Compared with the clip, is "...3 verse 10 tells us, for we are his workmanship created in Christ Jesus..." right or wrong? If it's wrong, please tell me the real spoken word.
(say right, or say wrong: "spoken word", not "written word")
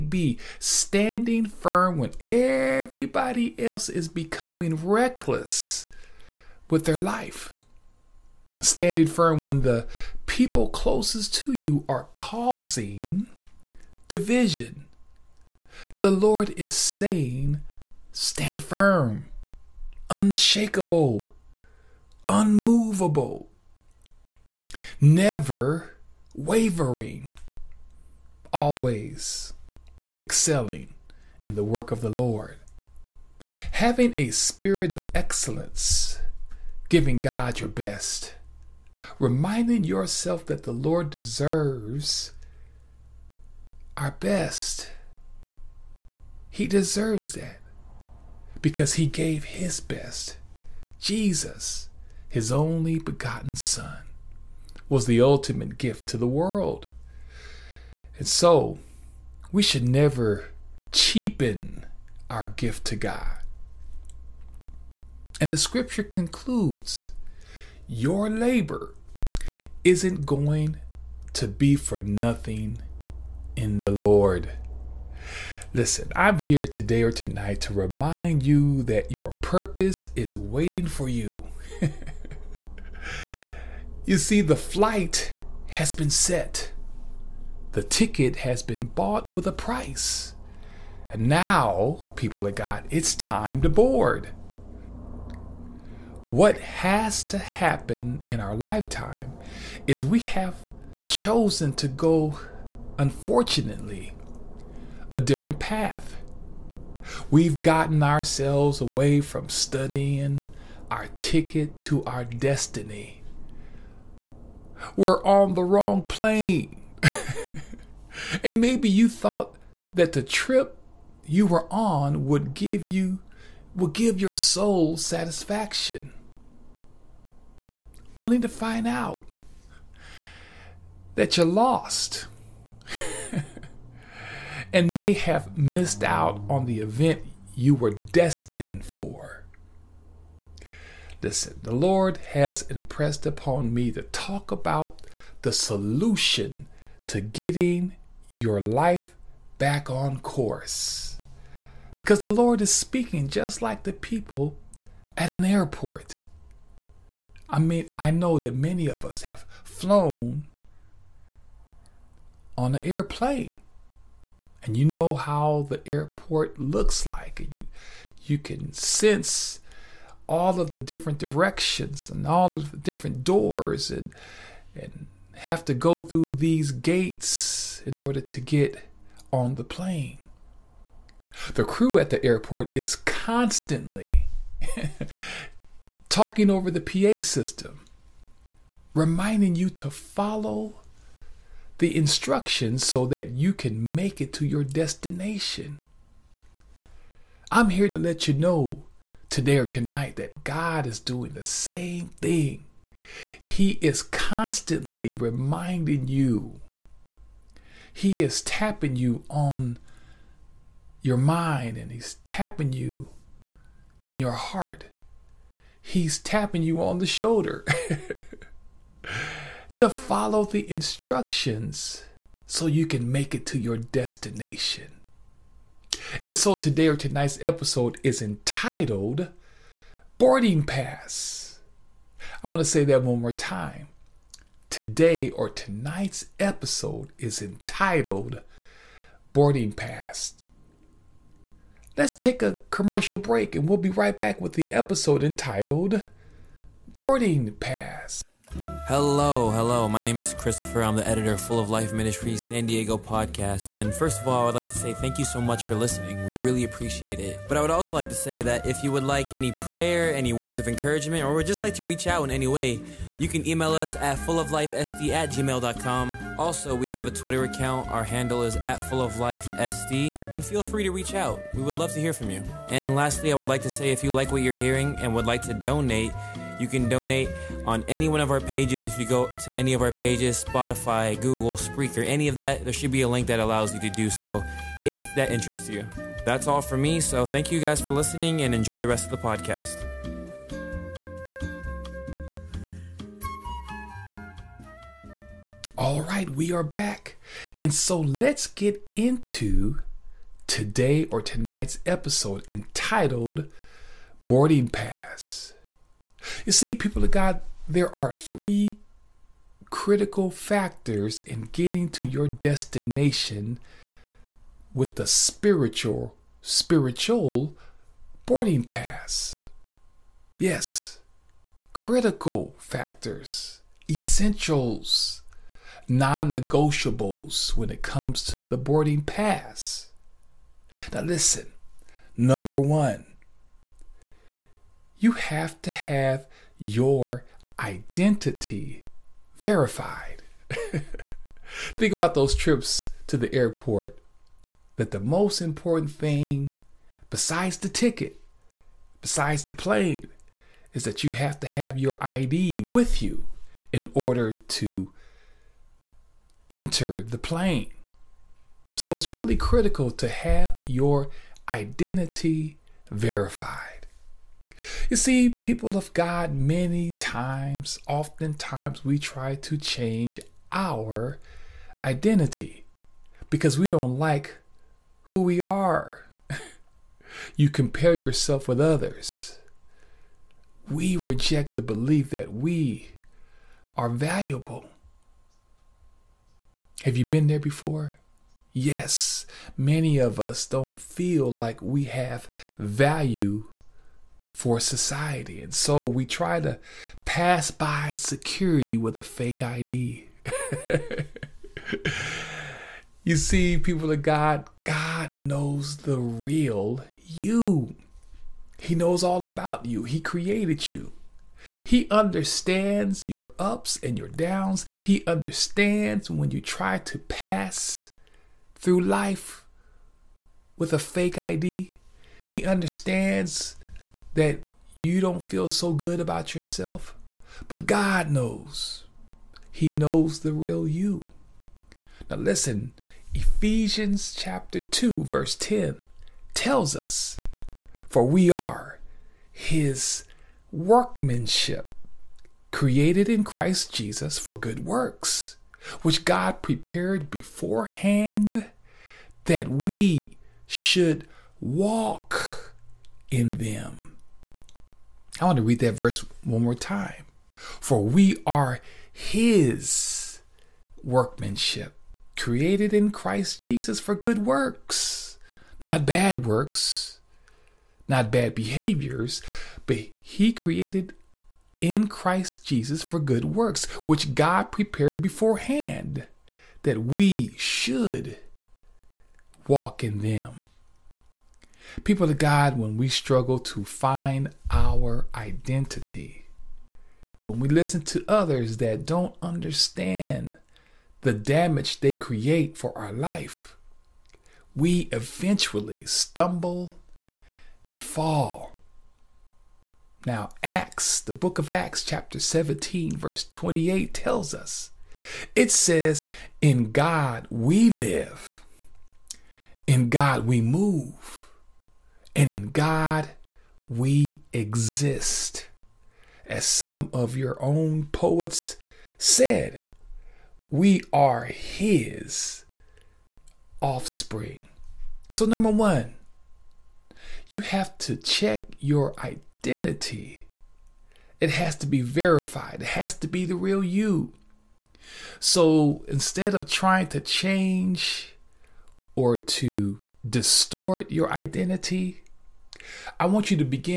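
wrong: "2", not "3".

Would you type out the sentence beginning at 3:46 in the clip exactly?
And so today or tonight's episode is entitled Boarding Pass.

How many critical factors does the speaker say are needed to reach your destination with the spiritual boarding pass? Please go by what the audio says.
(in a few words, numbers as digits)
3.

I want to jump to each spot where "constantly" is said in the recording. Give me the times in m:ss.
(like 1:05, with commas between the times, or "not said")
3:02, 3:24.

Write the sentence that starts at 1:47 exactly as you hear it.
We've gotten ourselves away from studying our ticket to our destiny.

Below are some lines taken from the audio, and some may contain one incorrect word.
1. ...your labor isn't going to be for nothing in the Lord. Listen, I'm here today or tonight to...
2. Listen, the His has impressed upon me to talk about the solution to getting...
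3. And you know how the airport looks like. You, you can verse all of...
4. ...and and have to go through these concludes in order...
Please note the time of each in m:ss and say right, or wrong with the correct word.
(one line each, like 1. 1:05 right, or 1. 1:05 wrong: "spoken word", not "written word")
1. 1:07 right
2. 2:21 wrong: "Lord", not "His"
3. 2:44 wrong: "sense", not "verse"
4. 2:53 wrong: "gates", not "concludes".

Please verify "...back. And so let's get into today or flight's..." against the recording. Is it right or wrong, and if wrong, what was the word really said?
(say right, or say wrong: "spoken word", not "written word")
wrong: "tonight", not "flight".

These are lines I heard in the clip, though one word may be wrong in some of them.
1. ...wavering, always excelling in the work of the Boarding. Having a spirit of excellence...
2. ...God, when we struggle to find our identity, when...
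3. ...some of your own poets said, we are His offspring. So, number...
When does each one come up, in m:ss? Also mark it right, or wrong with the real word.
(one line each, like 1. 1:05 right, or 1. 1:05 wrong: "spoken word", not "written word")
1. 0:26 wrong: "Lord", not "Boarding"
2. 8:02 right
3. 8:36 right.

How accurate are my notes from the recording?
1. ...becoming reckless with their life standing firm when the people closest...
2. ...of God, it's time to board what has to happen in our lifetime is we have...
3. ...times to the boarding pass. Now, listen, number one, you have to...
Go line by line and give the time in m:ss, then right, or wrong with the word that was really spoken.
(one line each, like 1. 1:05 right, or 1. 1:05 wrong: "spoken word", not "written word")
1. 0:04 right
2. 1:32 right
3. 5:27 wrong: "comes", not "times".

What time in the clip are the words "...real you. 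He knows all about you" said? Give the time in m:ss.
6:46.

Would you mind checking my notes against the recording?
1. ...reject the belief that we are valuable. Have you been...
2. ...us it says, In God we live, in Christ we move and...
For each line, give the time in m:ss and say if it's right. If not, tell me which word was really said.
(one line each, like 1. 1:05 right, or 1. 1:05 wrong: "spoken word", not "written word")
1. 6:20 right
2. 8:24 wrong: "God", not "Christ".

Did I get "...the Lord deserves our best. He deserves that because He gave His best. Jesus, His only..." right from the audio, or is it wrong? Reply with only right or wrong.
right.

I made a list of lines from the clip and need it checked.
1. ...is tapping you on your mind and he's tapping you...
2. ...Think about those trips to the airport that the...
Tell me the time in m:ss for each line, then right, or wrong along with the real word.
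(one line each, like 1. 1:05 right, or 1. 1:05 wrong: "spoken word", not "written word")
1. 3:28 right
2. 5:41 right.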